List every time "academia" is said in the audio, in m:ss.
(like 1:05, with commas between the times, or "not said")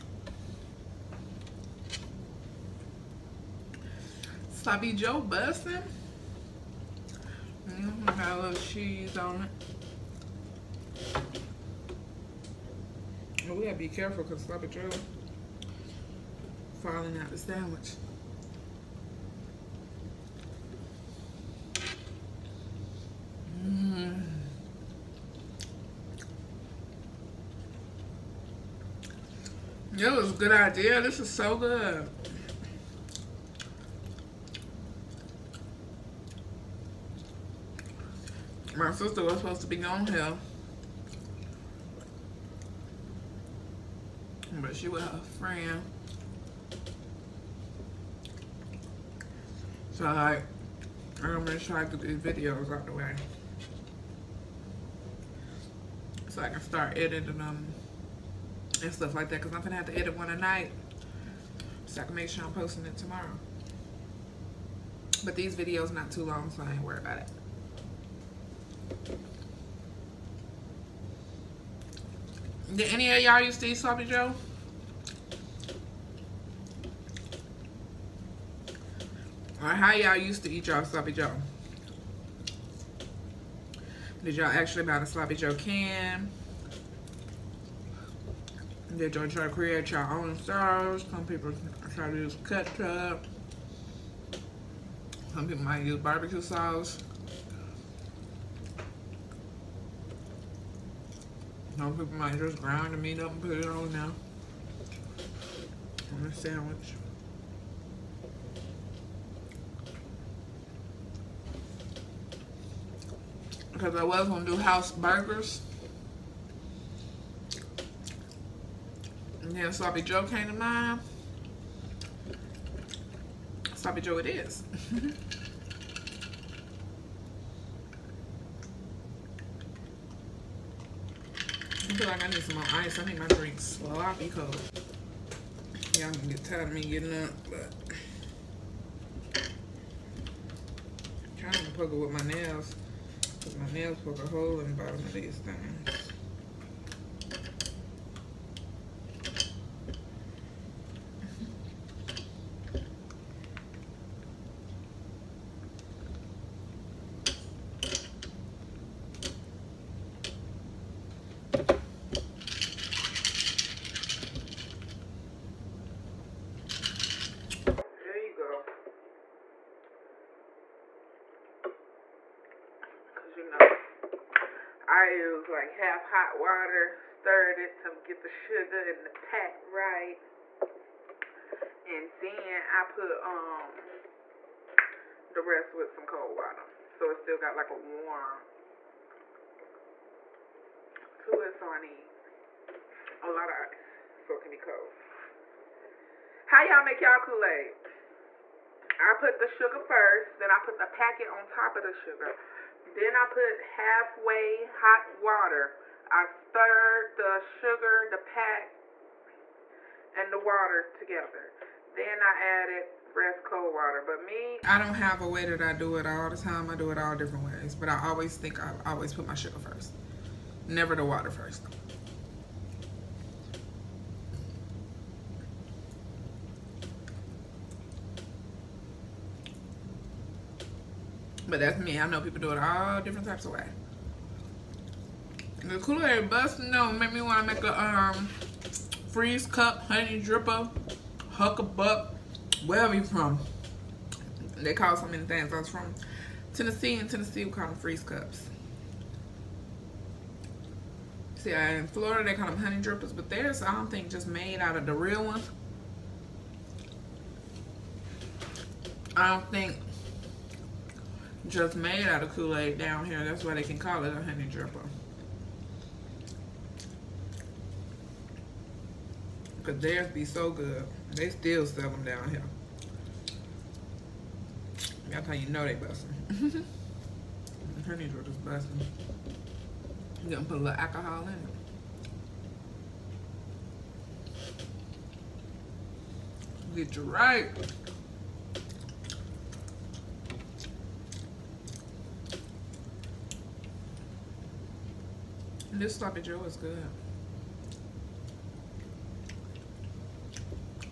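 not said.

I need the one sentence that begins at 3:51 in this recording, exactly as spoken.
I know people do it all different types of ways.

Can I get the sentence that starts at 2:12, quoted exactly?
I need my drink sloppy cold.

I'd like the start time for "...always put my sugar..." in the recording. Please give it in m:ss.
3:38.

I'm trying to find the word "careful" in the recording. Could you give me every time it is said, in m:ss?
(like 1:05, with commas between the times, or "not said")
0:13.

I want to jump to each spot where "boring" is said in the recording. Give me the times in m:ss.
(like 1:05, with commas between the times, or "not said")
not said.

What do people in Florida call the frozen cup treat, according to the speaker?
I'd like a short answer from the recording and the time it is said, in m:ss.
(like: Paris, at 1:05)
honey drippers, at 4:12.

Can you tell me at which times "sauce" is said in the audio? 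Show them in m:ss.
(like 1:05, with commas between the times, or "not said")
1:30, 1:36.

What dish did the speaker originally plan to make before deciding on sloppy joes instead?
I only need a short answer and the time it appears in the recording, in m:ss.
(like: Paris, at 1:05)
house burgers, at 1:54.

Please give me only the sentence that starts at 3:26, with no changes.
I stirred the sugar, the pack, and the water together.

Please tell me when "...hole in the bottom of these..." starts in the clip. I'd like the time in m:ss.
2:24.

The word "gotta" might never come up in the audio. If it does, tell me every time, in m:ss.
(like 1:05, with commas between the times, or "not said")
0:13.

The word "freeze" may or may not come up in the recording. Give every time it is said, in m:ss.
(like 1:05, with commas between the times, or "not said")
3:59, 4:07.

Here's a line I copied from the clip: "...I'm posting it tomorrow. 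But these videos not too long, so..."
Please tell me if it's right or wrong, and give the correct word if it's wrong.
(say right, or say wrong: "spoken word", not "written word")
right.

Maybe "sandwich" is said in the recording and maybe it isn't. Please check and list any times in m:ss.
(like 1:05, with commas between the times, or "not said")
0:17, 1:46.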